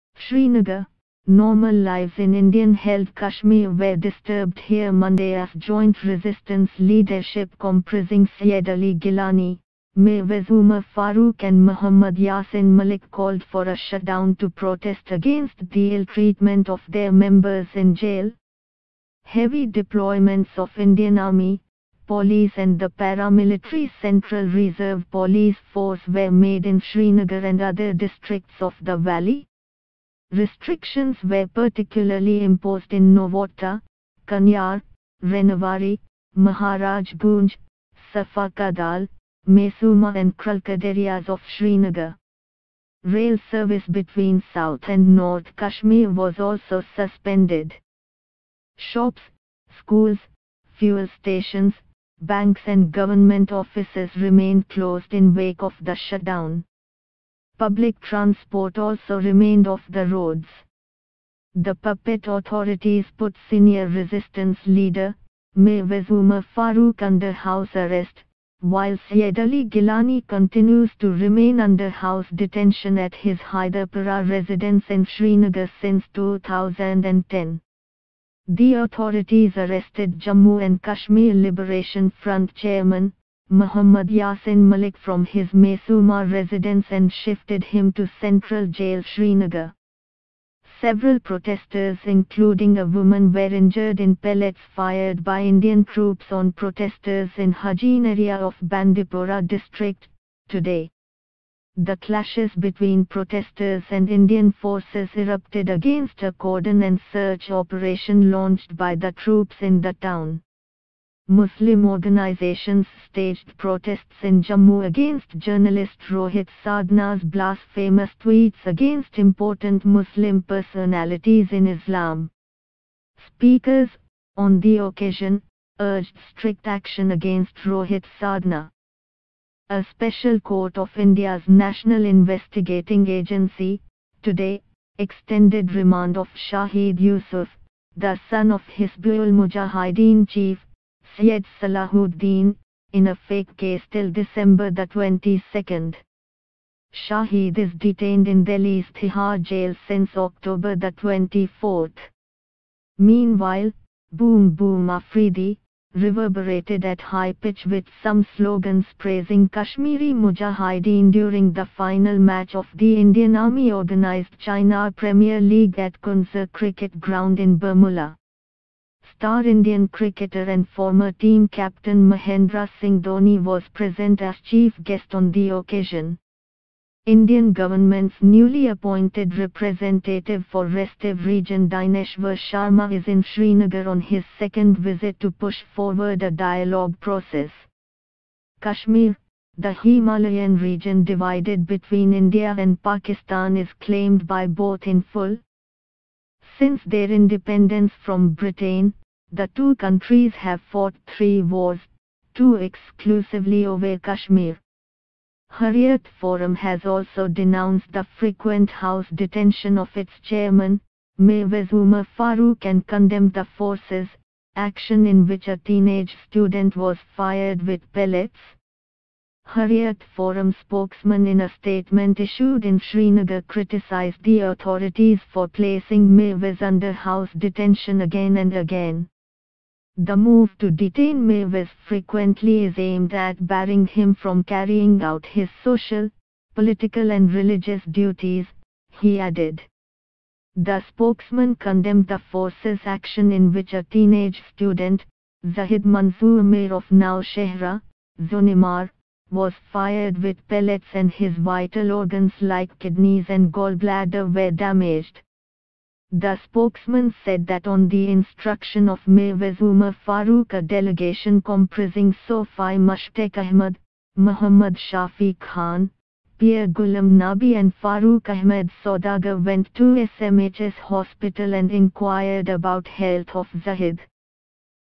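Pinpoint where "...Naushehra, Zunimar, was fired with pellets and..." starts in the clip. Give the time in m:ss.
4:06.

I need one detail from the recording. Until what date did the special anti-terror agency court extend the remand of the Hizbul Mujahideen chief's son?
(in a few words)
December 22.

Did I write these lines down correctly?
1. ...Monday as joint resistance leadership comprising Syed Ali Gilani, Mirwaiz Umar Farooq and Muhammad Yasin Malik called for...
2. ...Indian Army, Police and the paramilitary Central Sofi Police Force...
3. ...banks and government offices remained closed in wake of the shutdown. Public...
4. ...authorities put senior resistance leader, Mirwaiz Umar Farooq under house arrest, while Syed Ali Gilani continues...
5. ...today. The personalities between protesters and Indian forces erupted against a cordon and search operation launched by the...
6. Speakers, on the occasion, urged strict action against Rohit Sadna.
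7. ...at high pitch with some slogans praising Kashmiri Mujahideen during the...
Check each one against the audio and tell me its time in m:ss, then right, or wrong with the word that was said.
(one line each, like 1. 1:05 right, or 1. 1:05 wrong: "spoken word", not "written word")
1. 0:04 right
2. 0:20 wrong: "Reserve", not "Sofi"
3. 0:52 right
4. 1:02 right
5. 1:40 wrong: "clashes", not "personalities"
6. 2:03 right
7. 2:36 right.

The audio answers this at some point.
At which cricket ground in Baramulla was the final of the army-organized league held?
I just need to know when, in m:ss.
2:45.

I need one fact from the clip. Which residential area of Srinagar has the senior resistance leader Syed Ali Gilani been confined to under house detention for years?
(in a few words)
Hyderpara.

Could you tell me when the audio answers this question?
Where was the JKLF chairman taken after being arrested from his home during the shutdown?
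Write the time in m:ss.
1:28.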